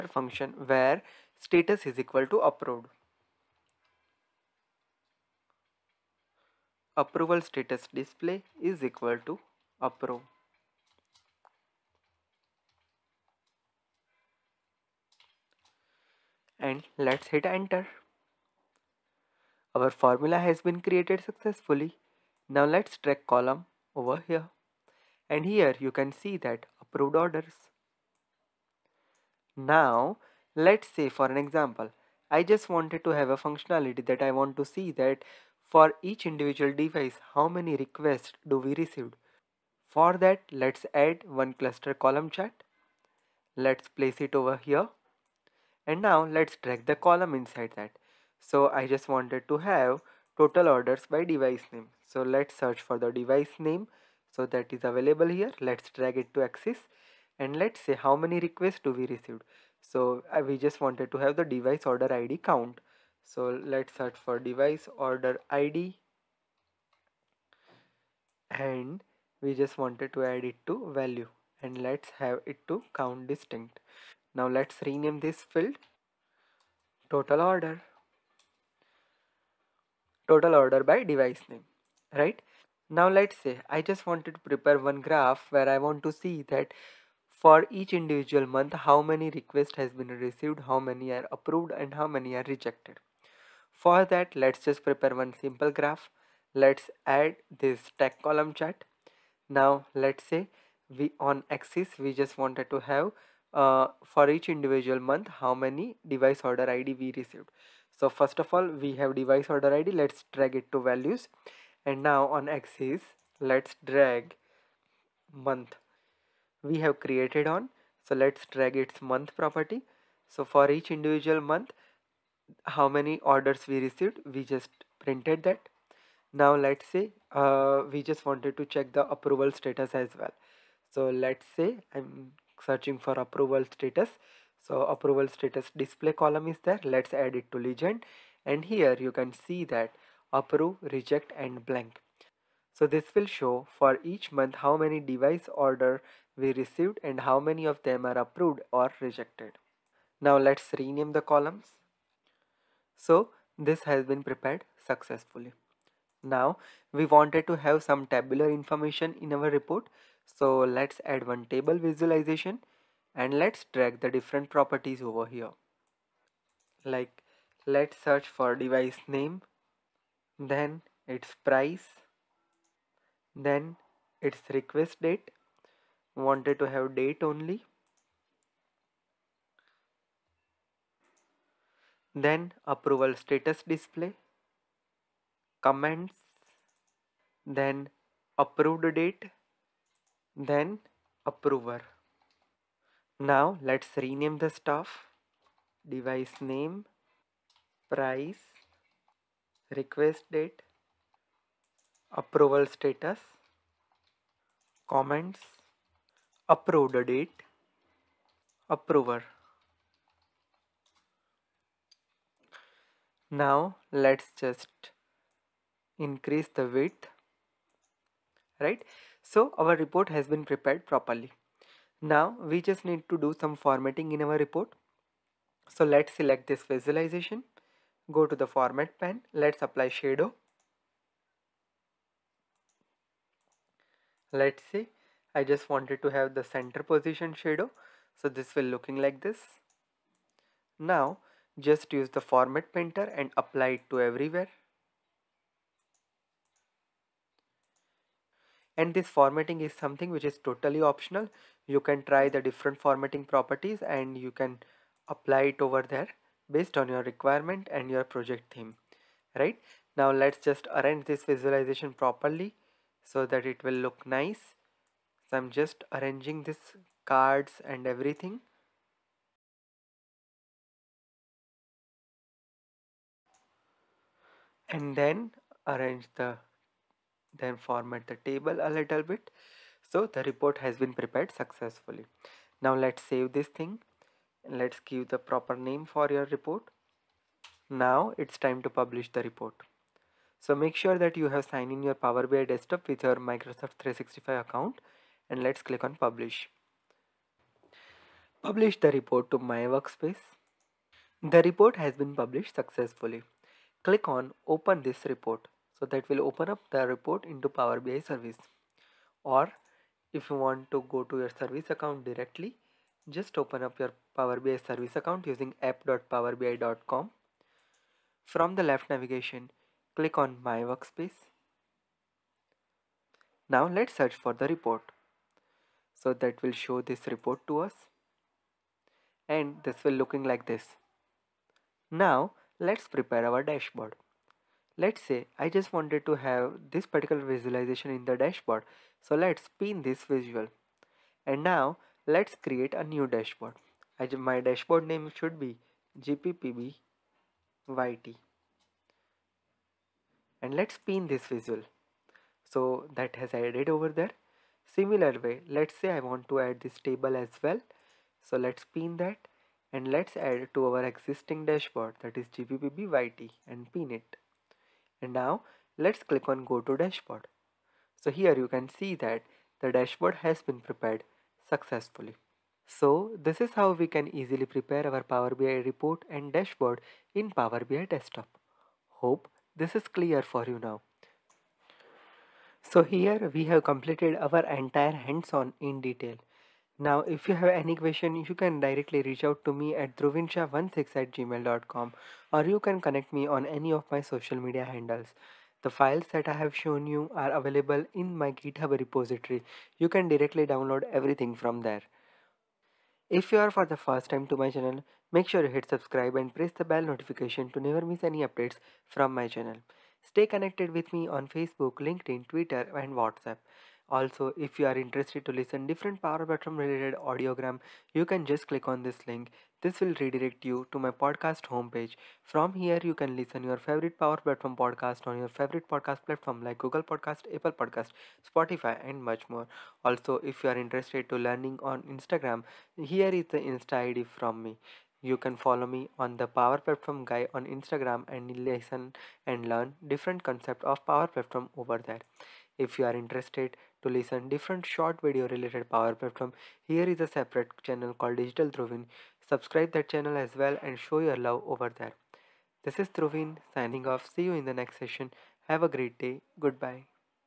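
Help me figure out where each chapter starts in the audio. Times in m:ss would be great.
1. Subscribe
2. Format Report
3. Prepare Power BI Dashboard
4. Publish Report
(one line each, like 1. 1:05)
1. 6:34
2. 3:45
3. 5:36
4. 4:51.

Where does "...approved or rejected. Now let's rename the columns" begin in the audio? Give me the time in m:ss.
2:28.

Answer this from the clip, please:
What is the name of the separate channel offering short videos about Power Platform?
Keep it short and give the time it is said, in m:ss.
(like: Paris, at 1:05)
Digital Dhruvin, at 7:28.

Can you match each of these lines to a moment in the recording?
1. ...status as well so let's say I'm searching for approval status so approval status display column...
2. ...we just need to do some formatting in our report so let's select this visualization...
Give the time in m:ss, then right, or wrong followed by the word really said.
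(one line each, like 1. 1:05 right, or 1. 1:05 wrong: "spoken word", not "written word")
1. 2:09 right
2. 3:42 right.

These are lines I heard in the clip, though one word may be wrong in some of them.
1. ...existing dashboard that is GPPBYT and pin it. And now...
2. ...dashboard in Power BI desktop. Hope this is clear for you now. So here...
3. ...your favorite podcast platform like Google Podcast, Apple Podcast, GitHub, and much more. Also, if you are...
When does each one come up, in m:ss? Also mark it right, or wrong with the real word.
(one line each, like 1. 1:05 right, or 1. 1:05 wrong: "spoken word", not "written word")
1. 6:00 right
2. 6:16 right
3. 7:05 wrong: "Spotify", not "GitHub".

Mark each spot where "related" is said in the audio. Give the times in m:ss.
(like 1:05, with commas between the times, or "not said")
6:56, 7:25.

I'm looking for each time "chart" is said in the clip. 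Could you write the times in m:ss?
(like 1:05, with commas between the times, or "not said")
0:42, 1:38.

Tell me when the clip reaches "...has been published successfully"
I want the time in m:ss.
5:01.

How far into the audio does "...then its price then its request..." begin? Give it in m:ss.
2:50.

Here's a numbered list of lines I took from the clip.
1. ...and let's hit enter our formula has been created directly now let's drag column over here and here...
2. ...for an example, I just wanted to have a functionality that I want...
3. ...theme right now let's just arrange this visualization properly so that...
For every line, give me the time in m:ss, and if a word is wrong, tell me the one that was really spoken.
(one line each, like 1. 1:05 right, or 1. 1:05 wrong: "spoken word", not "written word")
1. 0:16 wrong: "successfully", not "directly"
2. 0:31 right
3. 4:18 right.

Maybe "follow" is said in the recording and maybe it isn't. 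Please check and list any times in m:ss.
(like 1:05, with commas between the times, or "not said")
7:15.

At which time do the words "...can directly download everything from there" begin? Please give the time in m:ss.
6:39.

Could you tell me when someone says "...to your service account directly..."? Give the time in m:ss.
5:11.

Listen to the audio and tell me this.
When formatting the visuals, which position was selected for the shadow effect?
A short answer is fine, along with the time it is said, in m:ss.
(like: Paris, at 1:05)
Center, at 3:56.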